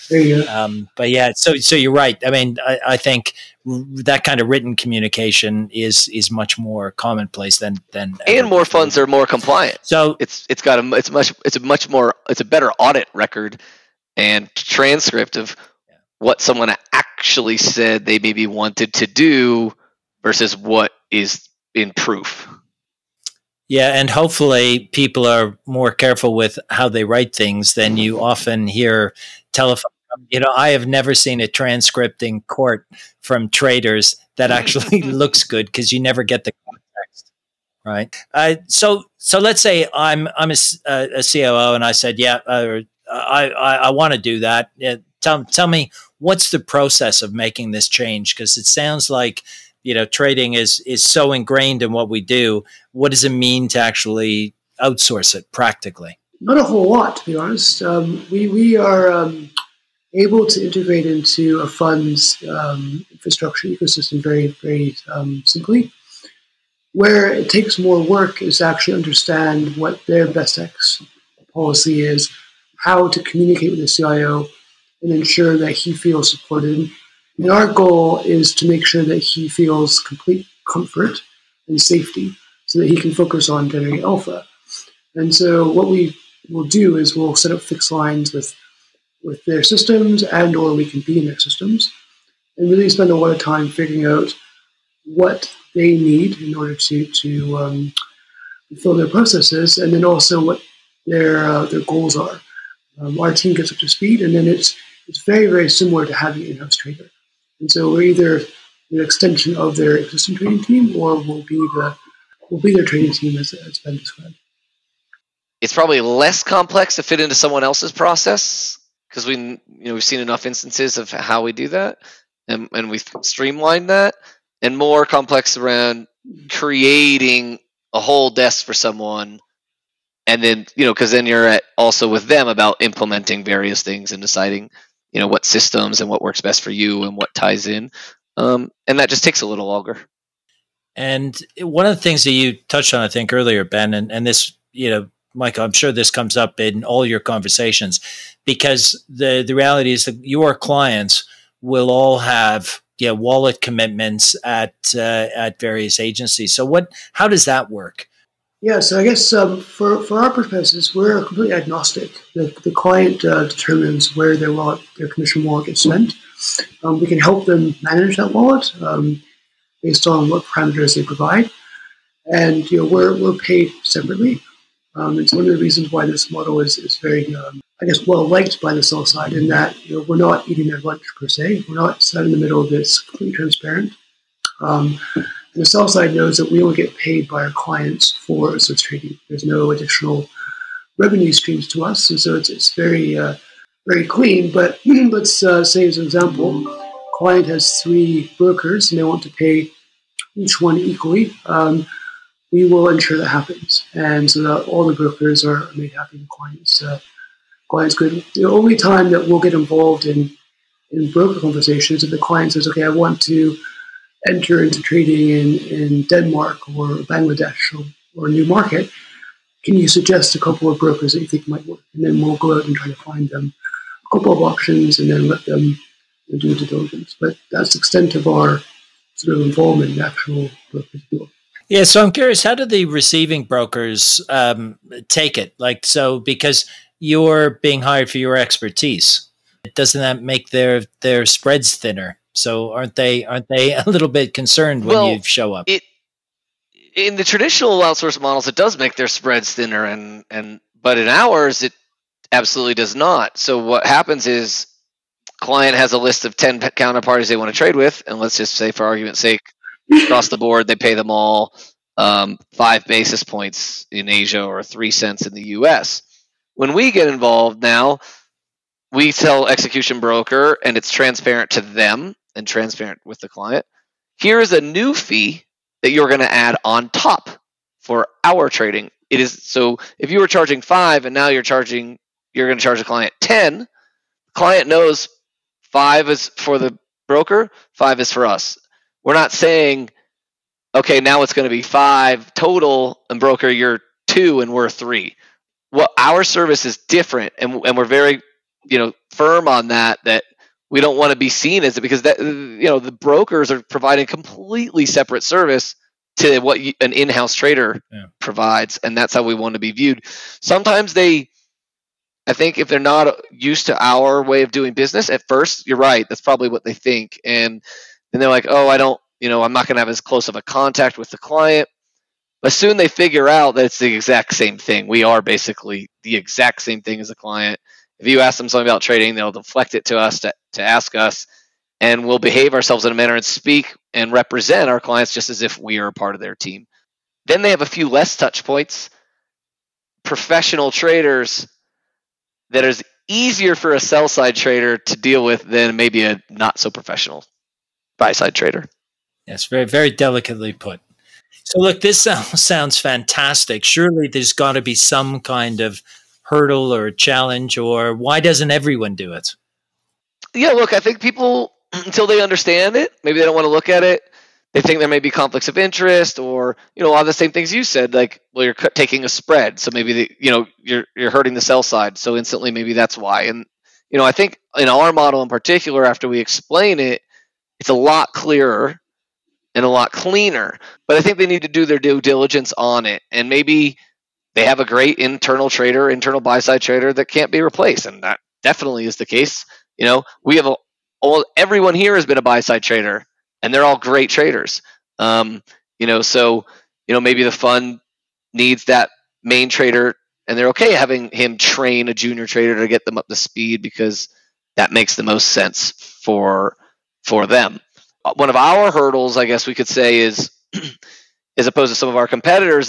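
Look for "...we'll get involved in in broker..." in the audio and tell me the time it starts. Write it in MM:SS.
03:29.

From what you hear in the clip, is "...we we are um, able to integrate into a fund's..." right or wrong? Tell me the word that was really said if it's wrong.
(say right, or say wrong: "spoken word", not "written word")
right.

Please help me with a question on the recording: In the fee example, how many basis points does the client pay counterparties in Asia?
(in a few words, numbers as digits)
5 basis points.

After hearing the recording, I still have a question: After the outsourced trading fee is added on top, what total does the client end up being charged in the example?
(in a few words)
10.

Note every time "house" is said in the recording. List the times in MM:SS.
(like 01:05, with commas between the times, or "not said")
01:46, 05:06.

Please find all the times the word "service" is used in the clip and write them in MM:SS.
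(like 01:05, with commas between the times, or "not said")
04:56, 05:05.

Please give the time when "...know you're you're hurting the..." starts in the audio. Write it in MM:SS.
06:10.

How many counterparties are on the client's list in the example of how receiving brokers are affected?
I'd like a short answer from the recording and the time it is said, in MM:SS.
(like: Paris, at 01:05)
10, at 04:16.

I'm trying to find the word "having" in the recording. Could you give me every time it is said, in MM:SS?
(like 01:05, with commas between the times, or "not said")
01:46, 06:40.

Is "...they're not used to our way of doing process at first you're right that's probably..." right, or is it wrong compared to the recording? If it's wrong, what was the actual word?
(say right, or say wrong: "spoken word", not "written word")
wrong: "business", not "process".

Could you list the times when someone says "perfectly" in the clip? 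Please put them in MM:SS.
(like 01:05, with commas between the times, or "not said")
not said.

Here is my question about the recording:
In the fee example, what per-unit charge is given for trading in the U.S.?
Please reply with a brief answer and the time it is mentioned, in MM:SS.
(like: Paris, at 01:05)
3 cents, at 04:24.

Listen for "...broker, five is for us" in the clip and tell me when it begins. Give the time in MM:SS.
04:47.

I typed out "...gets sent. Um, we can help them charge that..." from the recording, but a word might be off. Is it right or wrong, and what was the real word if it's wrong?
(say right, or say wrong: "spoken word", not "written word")
wrong: "manage", not "charge".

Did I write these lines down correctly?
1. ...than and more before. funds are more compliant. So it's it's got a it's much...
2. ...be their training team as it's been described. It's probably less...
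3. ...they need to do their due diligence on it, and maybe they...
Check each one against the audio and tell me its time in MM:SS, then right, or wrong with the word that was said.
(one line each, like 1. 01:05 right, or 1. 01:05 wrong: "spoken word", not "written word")
1. 00:07 right
2. 01:52 right
3. 06:21 right.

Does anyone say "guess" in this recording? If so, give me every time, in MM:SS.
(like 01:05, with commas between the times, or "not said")
02:39, 02:57, 06:49.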